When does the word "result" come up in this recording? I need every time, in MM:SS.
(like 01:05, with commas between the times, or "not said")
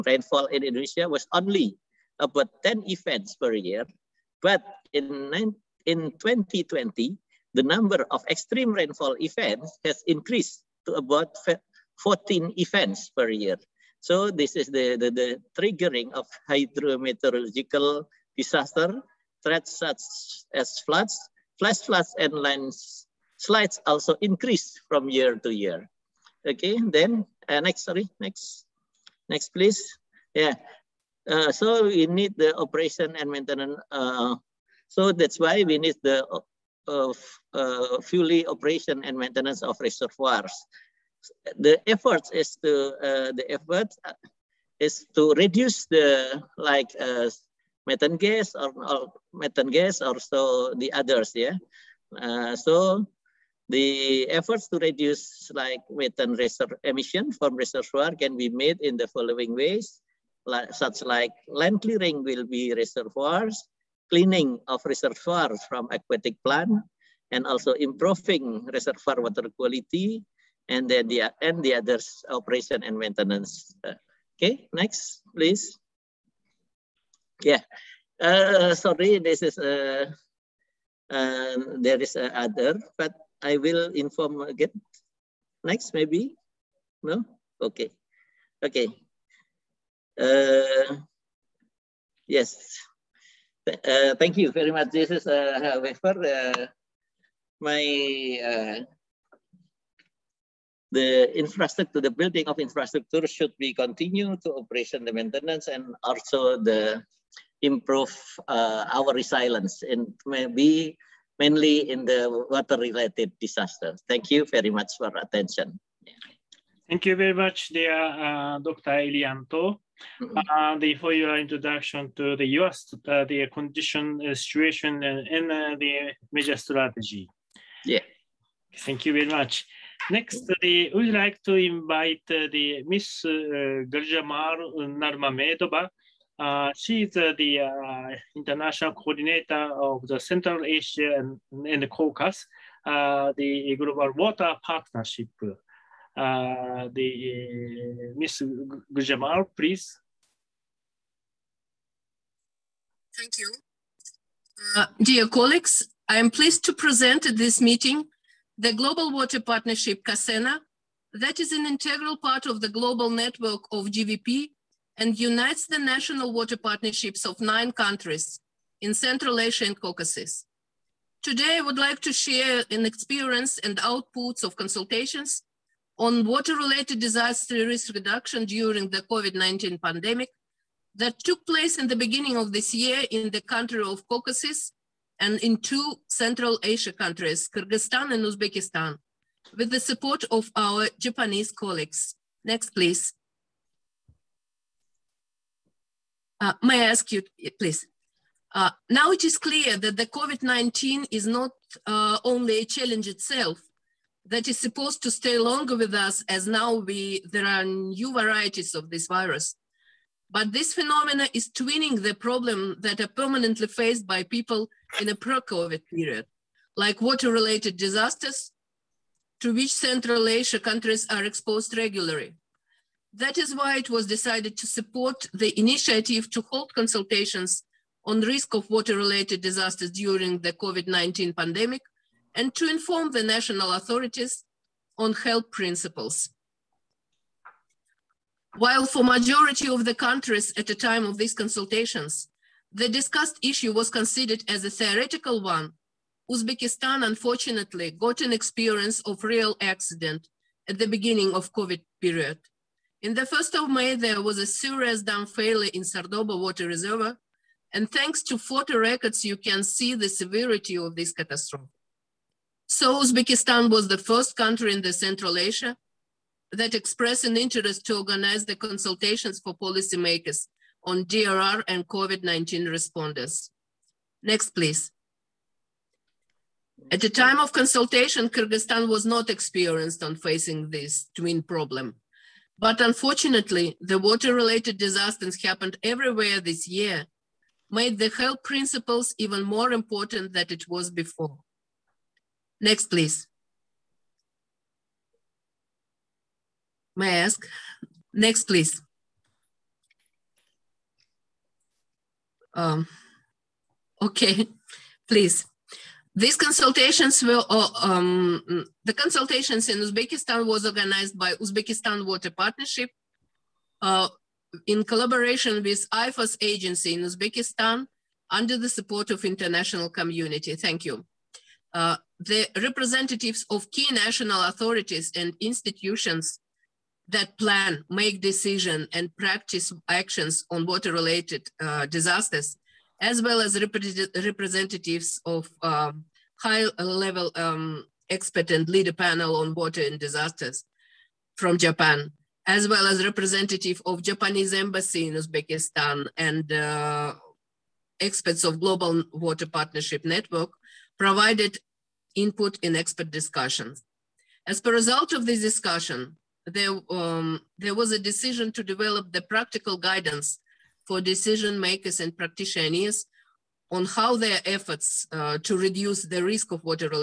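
05:54.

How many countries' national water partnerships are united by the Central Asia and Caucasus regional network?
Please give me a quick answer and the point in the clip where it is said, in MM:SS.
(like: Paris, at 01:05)
nine, at 02:47.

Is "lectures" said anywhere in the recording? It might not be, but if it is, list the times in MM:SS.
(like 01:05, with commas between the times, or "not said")
not said.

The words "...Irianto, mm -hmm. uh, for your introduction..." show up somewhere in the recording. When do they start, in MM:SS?
01:59.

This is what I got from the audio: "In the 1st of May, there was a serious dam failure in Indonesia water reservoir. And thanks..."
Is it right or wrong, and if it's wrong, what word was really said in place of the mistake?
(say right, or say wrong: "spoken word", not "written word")
wrong: "Sardoba", not "Indonesia".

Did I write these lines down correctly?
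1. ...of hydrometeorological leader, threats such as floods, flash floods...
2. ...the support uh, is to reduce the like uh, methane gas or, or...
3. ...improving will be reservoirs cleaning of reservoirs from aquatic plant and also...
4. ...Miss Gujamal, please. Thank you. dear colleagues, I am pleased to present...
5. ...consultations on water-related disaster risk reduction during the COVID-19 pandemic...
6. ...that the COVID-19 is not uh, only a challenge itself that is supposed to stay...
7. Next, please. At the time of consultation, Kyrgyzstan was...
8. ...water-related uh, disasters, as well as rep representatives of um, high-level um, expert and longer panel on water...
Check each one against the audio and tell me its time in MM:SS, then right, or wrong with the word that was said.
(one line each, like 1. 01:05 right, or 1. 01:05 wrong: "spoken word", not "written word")
1. 00:16 wrong: "disaster", not "leader"
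2. 00:43 wrong: "effort", not "support"
3. 01:01 wrong: "clearing", not "improving"
4. 02:28 right
5. 02:54 right
6. 03:19 right
7. 04:34 right
8. 05:30 wrong: "leader", not "longer".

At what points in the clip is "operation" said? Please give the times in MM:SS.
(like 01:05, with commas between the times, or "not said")
00:32, 00:38, 01:12, 01:44.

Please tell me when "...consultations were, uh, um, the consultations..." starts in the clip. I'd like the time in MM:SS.
05:06.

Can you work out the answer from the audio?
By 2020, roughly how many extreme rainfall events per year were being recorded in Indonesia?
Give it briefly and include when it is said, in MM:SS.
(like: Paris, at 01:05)
14, at 00:12.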